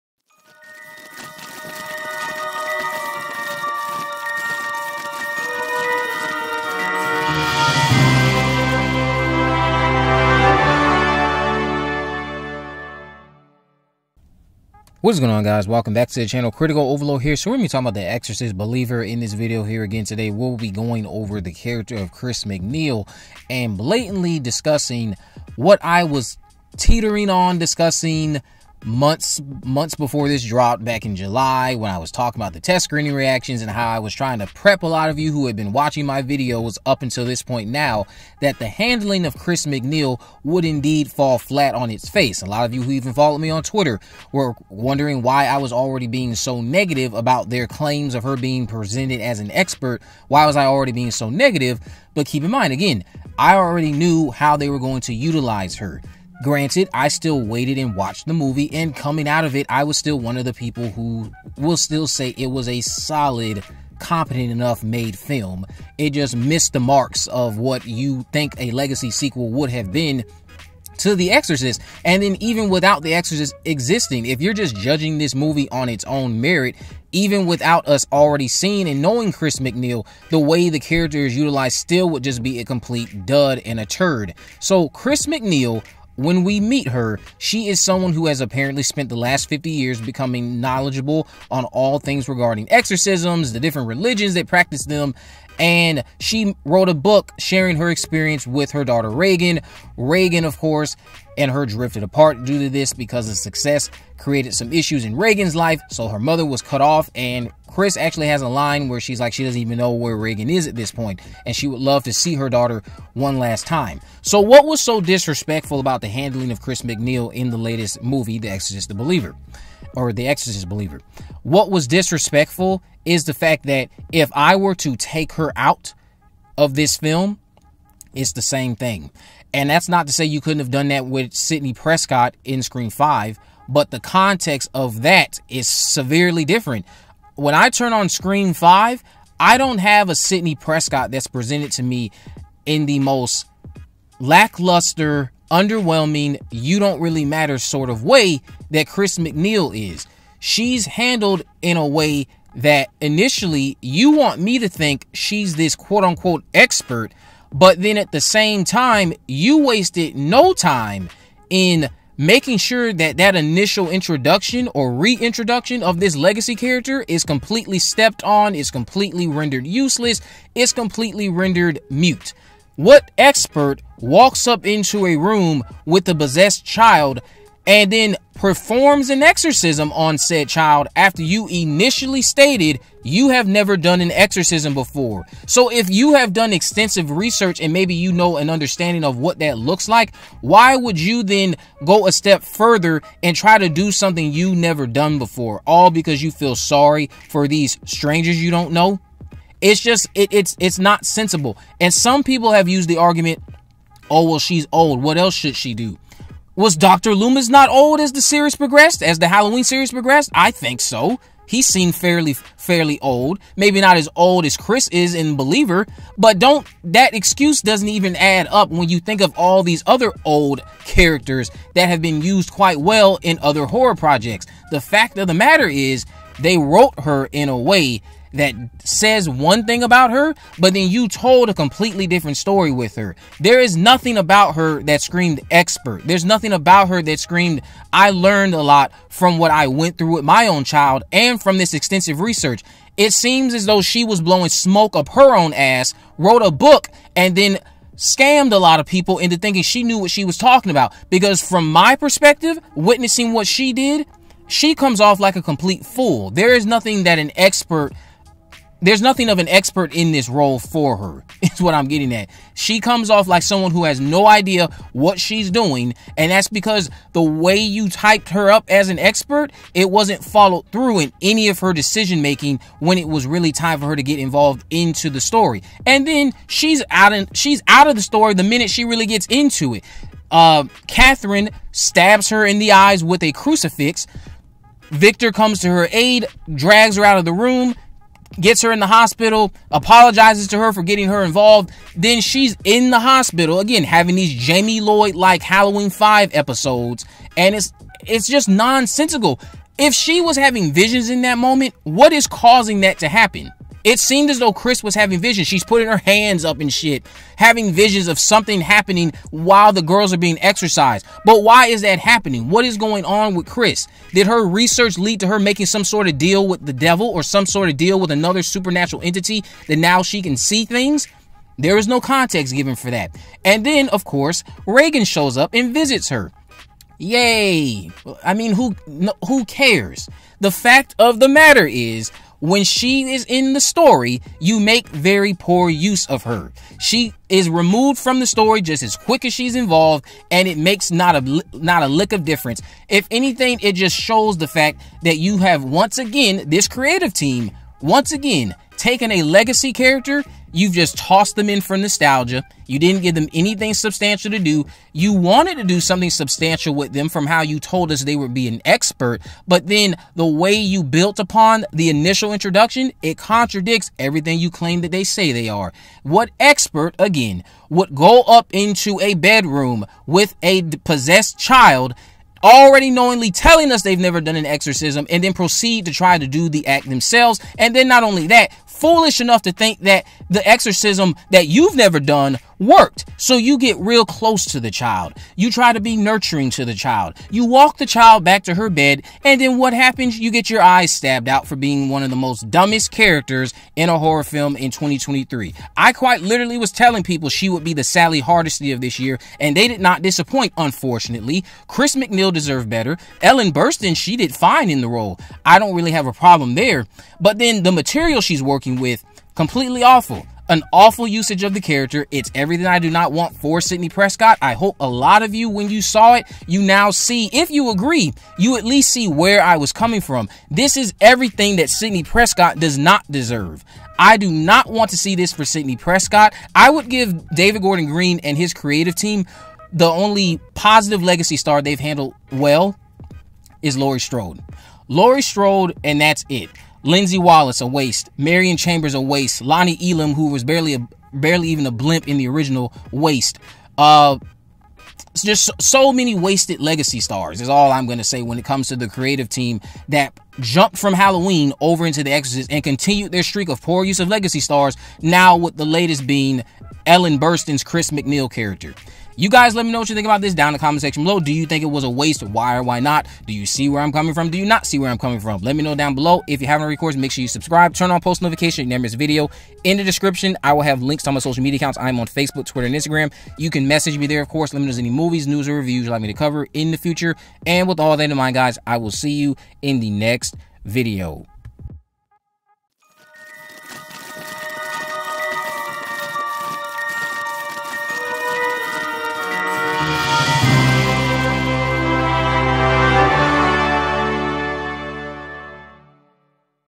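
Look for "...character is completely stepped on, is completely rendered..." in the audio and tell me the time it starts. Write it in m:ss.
2:46.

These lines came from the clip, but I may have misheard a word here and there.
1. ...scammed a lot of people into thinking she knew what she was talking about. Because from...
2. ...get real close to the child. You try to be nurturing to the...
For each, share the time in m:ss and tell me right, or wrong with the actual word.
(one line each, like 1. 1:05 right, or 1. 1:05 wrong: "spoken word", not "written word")
1. 4:07 right
2. 6:23 right.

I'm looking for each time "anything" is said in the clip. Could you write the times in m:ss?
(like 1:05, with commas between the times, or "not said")
5:43, 5:53.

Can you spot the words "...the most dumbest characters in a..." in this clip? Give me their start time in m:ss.
6:32.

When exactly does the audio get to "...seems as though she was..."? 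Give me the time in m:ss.
4:03.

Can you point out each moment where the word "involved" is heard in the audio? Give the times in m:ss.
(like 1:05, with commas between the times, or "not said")
4:34, 4:51, 5:39.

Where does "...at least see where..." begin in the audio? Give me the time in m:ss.
6:58.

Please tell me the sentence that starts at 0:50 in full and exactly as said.
Why was I already being so negative?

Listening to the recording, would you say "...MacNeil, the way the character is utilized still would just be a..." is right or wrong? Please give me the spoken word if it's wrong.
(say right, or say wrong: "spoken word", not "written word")
right.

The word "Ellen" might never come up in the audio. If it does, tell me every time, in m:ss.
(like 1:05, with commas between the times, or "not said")
6:43, 7:36.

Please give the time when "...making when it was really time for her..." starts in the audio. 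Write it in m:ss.
4:32.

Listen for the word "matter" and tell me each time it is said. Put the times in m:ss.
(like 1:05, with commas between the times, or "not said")
2:27, 3:45, 5:31.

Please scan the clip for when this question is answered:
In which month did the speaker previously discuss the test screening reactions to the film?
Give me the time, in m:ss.
0:31.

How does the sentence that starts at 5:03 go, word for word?
It seemed as though Chris was having visions.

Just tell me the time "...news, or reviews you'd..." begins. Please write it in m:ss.
7:55.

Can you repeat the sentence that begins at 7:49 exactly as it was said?
In the description, I will have links to all my social media accounts.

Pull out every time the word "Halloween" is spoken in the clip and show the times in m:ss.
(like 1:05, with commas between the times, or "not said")
3:29, 4:55, 7:30.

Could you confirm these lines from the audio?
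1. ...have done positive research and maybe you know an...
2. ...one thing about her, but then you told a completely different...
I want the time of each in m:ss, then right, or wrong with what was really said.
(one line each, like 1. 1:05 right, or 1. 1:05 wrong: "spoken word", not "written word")
1. 3:06 wrong: "extensive", not "positive"
2. 3:49 right.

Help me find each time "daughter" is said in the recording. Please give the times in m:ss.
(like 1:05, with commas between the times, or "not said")
1:38, 1:52.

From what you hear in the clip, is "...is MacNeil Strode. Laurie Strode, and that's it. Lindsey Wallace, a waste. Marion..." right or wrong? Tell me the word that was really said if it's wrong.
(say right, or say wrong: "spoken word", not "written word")
wrong: "Laurie", not "MacNeil".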